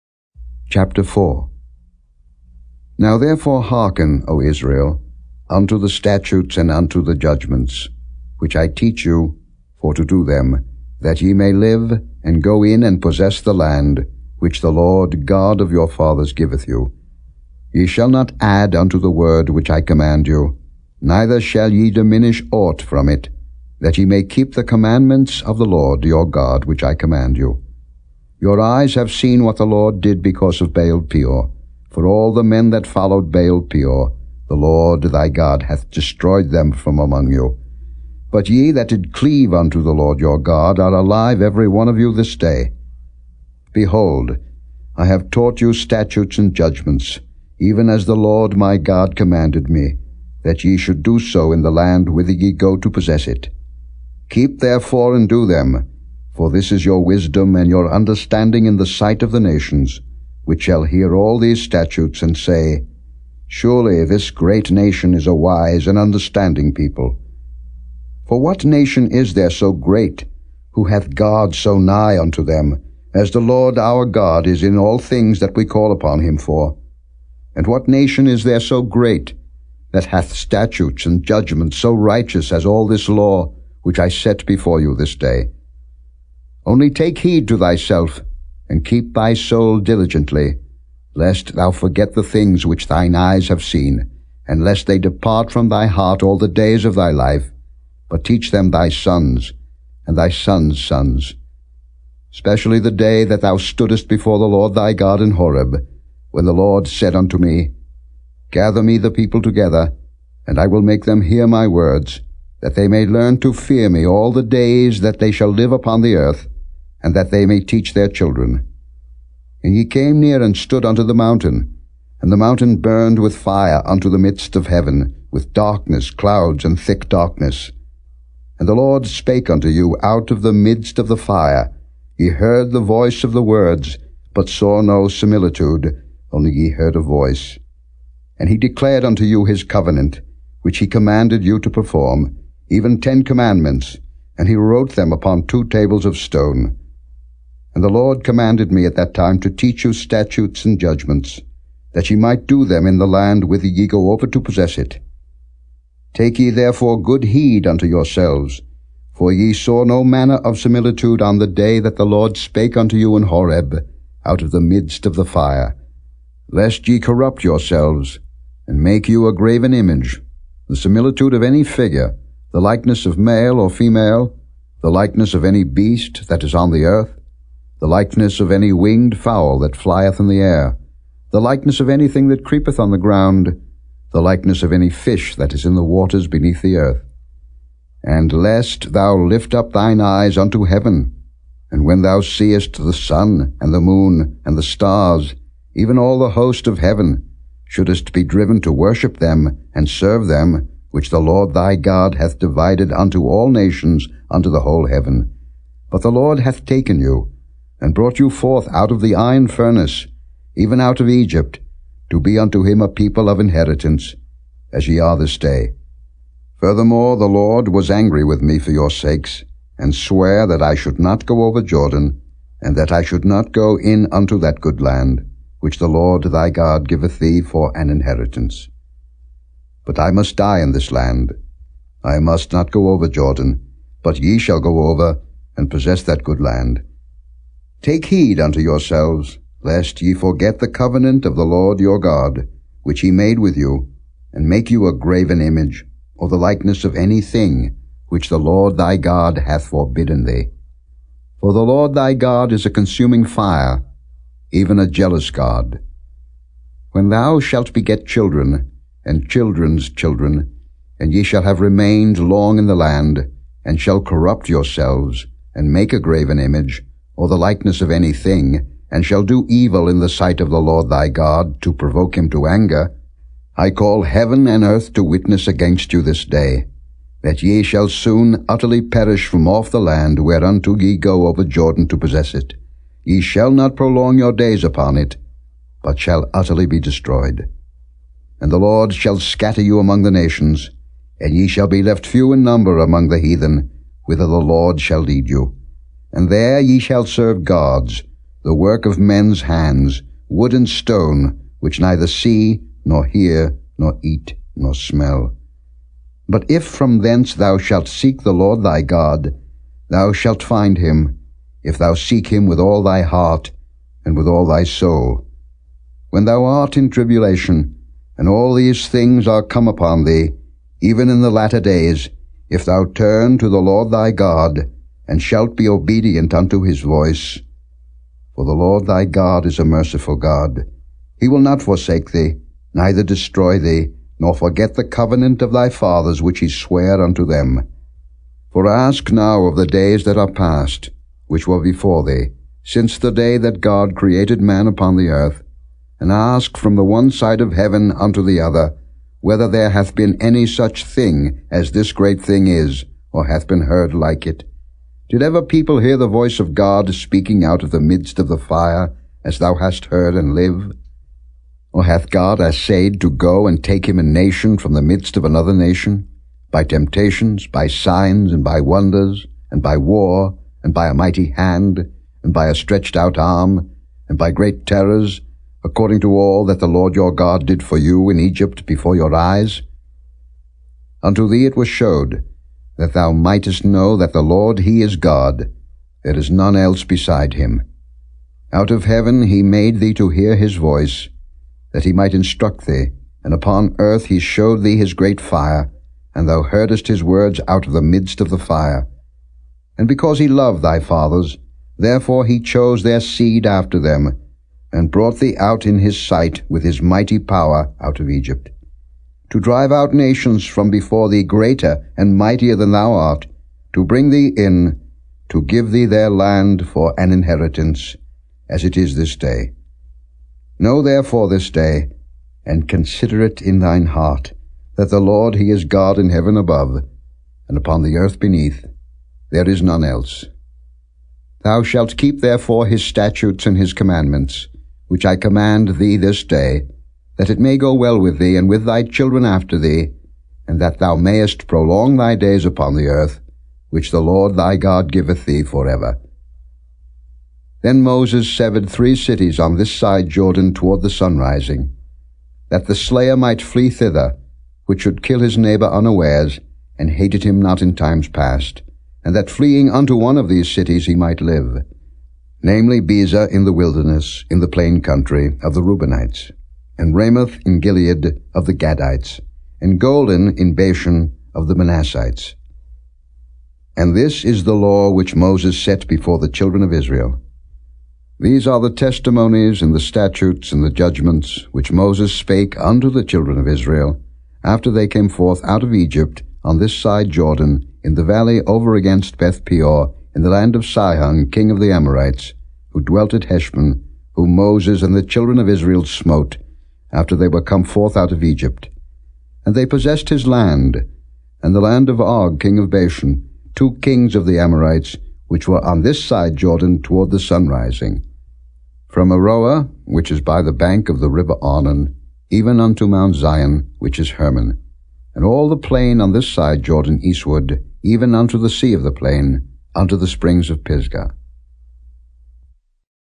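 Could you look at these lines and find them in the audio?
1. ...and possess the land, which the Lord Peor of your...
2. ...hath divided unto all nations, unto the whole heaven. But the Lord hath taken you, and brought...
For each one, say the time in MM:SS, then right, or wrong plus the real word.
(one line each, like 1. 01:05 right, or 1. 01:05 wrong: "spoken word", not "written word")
1. 00:12 wrong: "God", not "Peor"
2. 03:22 right.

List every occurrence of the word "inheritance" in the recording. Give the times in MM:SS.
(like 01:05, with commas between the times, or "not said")
03:33, 03:47, 06:57.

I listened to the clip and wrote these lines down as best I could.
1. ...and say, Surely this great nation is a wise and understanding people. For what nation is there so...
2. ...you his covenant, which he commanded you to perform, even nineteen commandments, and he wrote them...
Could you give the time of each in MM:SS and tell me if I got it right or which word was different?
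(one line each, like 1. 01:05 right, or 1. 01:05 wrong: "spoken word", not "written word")
1. 01:02 right
2. 02:19 wrong: "ten", not "nineteen".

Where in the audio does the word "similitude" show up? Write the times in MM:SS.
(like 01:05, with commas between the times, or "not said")
02:15, 02:40, 02:50.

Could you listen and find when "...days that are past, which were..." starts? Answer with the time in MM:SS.
05:39.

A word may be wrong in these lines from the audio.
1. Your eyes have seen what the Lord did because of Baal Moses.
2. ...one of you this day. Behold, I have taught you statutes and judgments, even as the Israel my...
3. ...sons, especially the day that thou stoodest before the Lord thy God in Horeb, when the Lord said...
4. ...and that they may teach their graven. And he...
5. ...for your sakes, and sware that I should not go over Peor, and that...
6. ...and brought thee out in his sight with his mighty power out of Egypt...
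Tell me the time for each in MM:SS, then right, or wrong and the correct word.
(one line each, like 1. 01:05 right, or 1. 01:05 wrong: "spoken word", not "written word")
1. 00:28 wrong: "Peor", not "Moses"
2. 00:41 wrong: "Lord", not "Israel"
3. 01:40 right
4. 01:57 wrong: "children", not "graven"
5. 03:38 wrong: "Jordan", not "Peor"
6. 06:44 right.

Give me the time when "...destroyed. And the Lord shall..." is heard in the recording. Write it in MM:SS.
04:46.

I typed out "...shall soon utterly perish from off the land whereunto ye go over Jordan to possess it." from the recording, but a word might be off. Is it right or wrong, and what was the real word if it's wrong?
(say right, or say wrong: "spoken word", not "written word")
right.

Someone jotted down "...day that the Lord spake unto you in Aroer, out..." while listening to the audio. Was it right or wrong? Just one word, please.
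wrong.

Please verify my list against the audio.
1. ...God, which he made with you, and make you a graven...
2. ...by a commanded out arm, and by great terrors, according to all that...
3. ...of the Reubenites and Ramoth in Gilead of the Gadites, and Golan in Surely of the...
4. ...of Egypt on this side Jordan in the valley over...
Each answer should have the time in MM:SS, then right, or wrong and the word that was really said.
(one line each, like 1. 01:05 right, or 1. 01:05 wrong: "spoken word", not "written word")
1. 04:01 right
2. 06:12 wrong: "stretched", not "commanded"
3. 07:45 wrong: "Bashan", not "Surely"
4. 08:05 right.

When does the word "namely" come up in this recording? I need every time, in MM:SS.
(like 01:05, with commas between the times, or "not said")
07:42.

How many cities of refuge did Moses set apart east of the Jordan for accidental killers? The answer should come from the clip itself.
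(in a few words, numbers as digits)
3.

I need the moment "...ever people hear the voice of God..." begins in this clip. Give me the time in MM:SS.
05:55.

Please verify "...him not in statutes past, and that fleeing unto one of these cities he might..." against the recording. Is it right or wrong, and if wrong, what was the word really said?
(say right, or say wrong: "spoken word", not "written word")
wrong: "times", not "statutes".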